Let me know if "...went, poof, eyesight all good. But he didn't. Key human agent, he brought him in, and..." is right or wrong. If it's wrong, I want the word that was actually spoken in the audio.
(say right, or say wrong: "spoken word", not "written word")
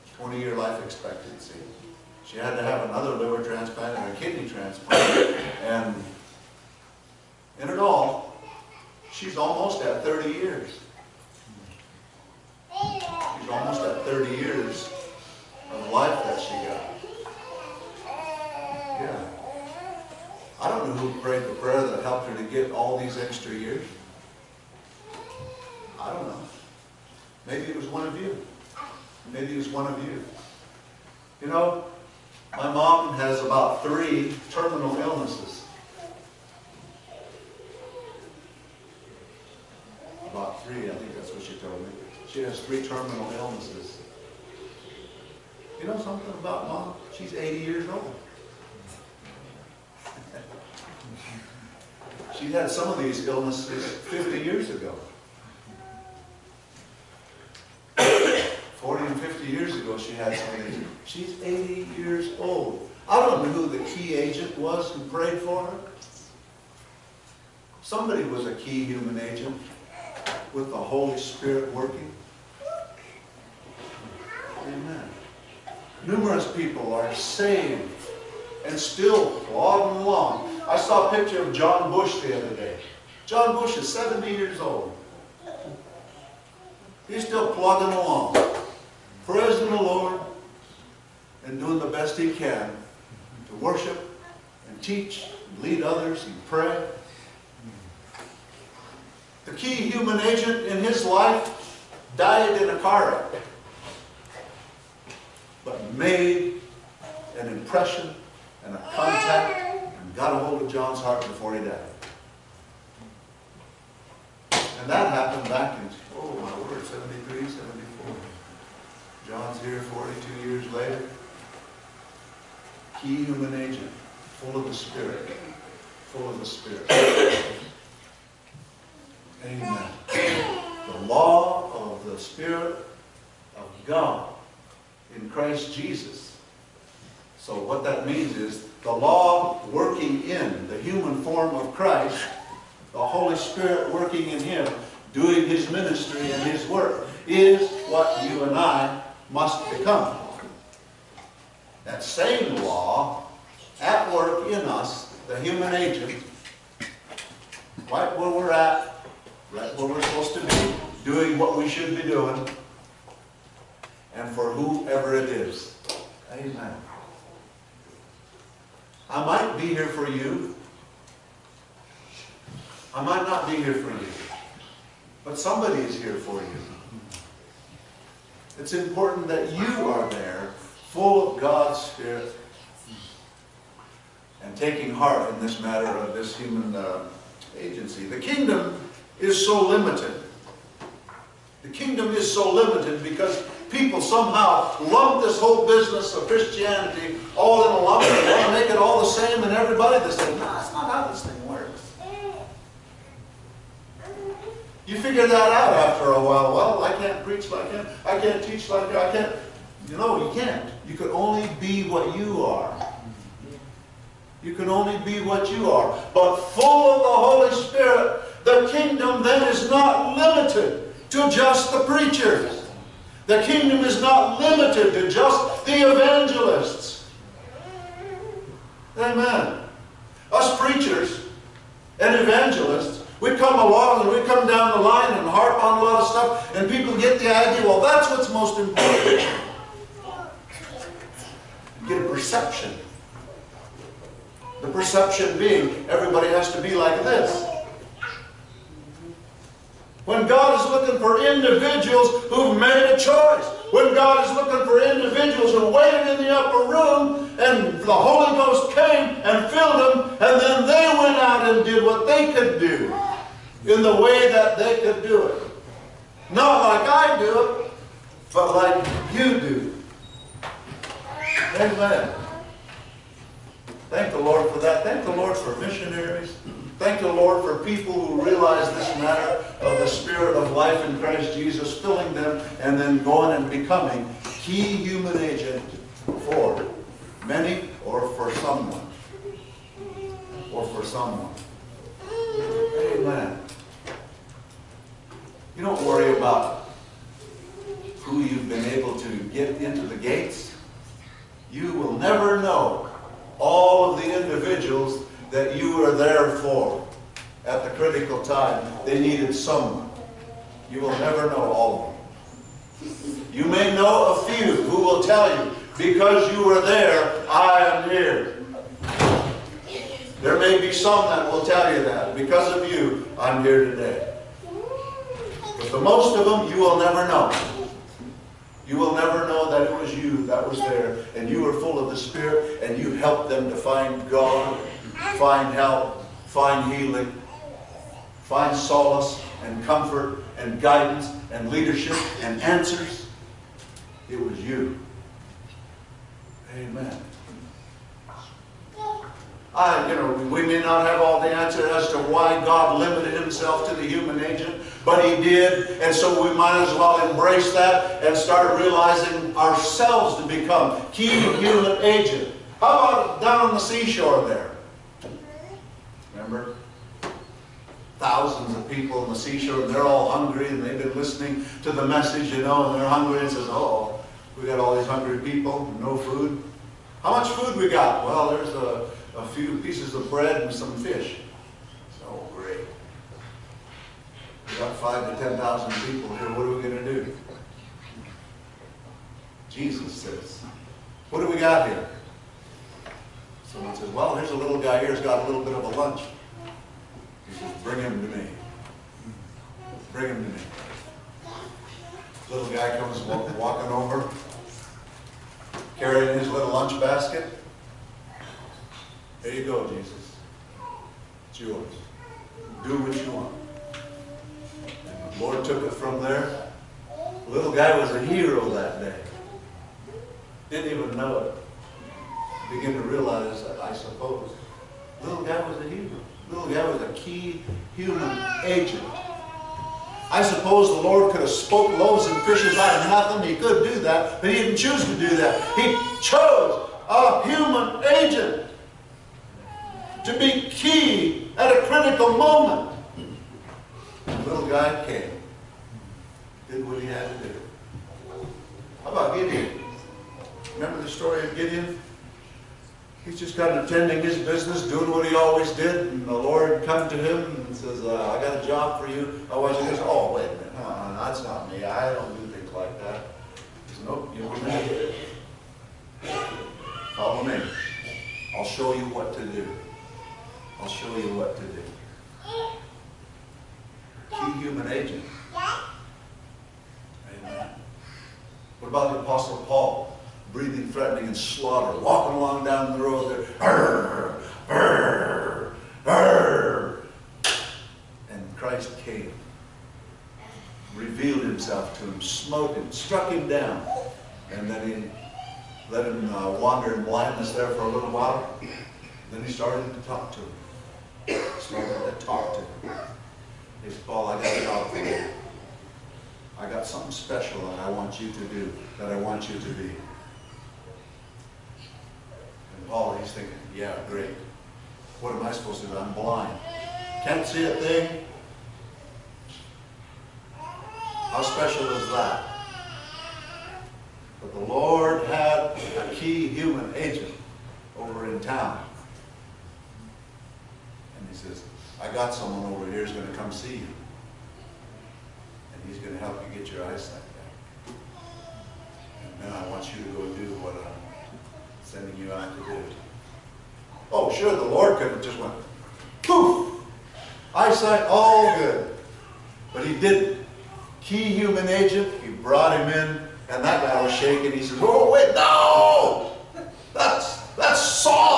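right.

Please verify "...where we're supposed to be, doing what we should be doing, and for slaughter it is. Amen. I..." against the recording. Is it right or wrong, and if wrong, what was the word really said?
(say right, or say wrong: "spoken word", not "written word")
wrong: "whoever", not "slaughter".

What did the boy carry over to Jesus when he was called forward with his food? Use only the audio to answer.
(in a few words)
lunch basket.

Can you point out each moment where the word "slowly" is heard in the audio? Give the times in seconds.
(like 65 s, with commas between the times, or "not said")
not said.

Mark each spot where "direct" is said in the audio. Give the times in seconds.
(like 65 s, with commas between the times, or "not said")
not said.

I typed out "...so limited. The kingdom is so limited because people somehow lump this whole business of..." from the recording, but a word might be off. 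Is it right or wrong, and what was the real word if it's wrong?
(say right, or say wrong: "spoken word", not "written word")
right.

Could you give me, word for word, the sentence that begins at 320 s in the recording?
There may be some that will tell you that.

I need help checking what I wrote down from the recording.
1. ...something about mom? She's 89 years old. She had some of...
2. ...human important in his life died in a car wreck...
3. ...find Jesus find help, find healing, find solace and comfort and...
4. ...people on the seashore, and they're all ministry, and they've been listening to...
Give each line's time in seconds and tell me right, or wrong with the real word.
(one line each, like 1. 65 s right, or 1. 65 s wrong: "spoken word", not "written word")
1. 45 s wrong: "80", not "89"
2. 99 s wrong: "agent", not "important"
3. 333 s wrong: "God", not "Jesus"
4. 368 s wrong: "hungry", not "ministry".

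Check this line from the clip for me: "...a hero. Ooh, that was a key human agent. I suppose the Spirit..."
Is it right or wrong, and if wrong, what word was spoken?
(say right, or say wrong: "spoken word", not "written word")
wrong: "Lord", not "Spirit".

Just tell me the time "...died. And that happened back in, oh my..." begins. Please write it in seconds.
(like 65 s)
111 s.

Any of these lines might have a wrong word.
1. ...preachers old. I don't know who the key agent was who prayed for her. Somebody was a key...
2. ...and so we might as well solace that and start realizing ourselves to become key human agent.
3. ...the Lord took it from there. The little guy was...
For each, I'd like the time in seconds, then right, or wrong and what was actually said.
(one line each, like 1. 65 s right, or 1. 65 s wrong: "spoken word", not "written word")
1. 61 s wrong: "years", not "preachers"
2. 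355 s wrong: "embrace", not "solace"
3. 415 s right.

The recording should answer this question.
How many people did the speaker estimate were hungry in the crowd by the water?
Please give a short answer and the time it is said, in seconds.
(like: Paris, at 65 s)
5 to 10,000, at 384 s.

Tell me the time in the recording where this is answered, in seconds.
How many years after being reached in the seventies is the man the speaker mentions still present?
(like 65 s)
119 s.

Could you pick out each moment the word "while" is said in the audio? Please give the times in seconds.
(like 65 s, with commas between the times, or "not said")
206 s, 497 s.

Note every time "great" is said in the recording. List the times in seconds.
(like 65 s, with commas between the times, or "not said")
382 s, 513 s.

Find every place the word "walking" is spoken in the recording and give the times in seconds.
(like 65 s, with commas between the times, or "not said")
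403 s, 481 s.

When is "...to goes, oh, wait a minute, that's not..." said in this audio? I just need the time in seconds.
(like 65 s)
459 s.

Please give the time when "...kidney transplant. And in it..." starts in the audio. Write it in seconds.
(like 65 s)
4 s.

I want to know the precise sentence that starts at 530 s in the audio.
And he says, I got someone over here who's going to come see you.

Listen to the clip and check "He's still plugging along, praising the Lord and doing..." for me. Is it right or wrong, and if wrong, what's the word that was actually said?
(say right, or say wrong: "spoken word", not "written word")
right.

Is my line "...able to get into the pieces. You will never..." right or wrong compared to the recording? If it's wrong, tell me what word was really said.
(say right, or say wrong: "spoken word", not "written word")
wrong: "gates", not "pieces".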